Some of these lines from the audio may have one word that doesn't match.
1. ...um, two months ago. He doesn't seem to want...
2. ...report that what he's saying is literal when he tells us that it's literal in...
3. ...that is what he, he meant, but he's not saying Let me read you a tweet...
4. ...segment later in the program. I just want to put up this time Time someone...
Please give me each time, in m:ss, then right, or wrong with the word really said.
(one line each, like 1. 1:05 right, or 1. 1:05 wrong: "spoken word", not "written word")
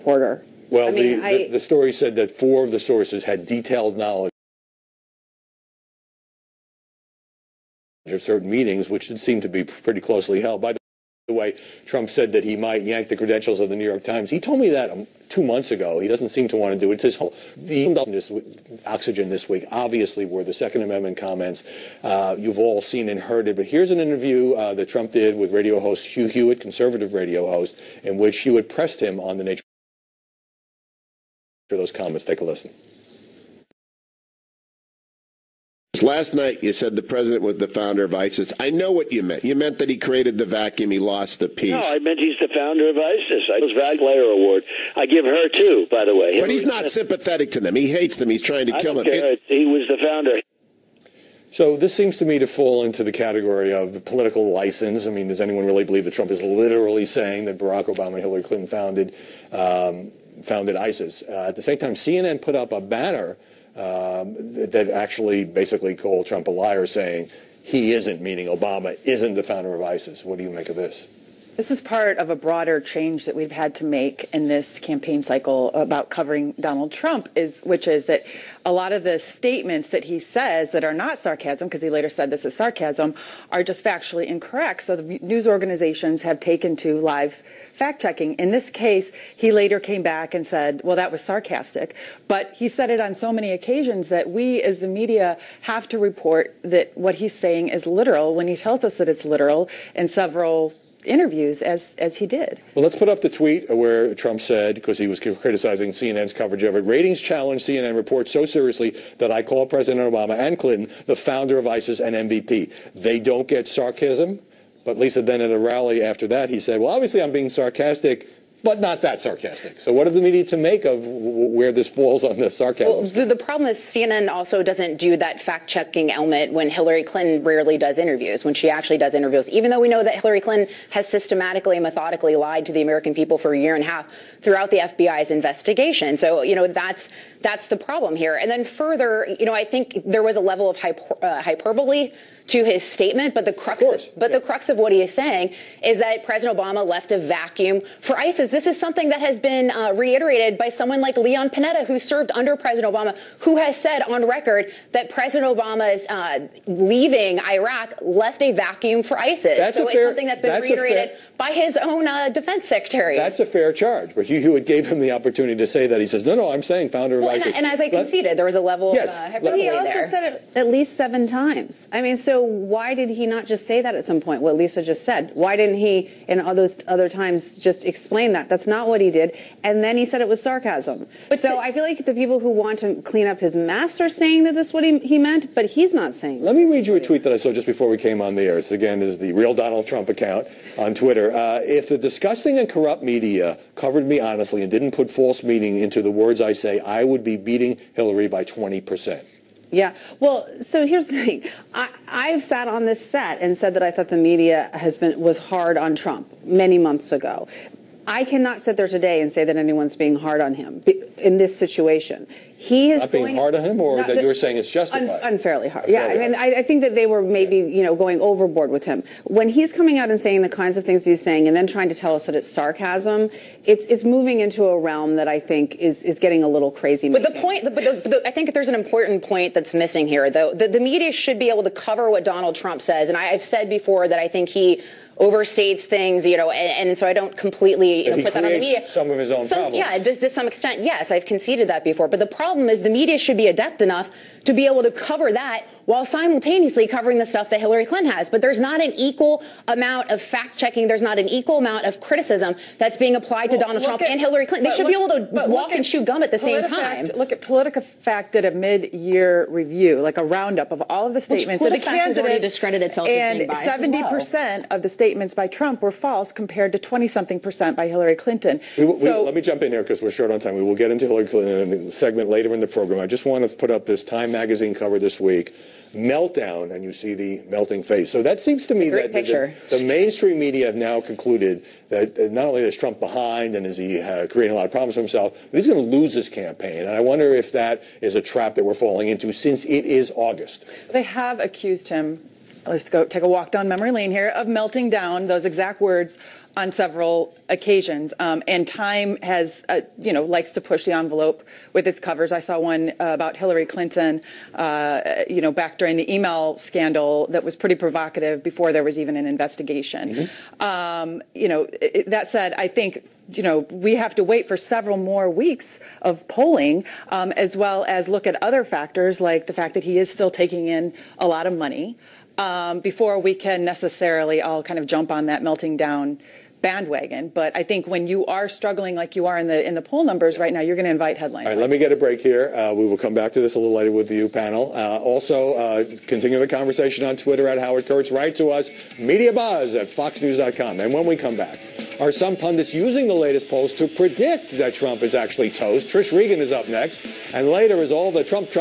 1. 0:14 right
2. 1:35 right
3. 3:04 right
4. 4:31 wrong: "magazine", not "someone".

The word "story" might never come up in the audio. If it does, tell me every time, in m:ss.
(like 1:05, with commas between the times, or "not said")
0:01.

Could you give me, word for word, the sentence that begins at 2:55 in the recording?
Why didn't he, in all those other times, just explain that?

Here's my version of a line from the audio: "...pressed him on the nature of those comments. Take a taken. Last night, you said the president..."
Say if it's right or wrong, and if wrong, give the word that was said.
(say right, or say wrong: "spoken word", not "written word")
wrong: "listen", not "taken".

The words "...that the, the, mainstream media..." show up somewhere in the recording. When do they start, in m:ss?
4:38.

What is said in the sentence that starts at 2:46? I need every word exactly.
He says, no, no, I'm saying founder well, of ISIS.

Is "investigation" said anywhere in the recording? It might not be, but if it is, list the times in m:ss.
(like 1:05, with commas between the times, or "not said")
2:15, 5:09.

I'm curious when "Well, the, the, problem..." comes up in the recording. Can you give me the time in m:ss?
2:02.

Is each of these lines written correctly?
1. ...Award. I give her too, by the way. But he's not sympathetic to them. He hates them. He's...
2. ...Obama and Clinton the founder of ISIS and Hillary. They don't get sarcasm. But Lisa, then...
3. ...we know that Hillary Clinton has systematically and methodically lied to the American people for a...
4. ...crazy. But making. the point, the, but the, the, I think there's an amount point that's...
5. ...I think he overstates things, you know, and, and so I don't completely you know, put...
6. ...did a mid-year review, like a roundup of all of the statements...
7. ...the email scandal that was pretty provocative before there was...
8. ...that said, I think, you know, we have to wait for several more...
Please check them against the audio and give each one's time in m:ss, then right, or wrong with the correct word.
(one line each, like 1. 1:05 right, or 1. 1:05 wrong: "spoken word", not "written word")
1. 0:43 right
2. 1:50 wrong: "MVP", not "Hillary"
3. 2:09 right
4. 3:46 wrong: "important", not "amount"
5. 3:54 right
6. 4:18 right
7. 5:05 right
8. 5:12 right.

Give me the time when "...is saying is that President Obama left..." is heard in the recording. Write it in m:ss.
2:25.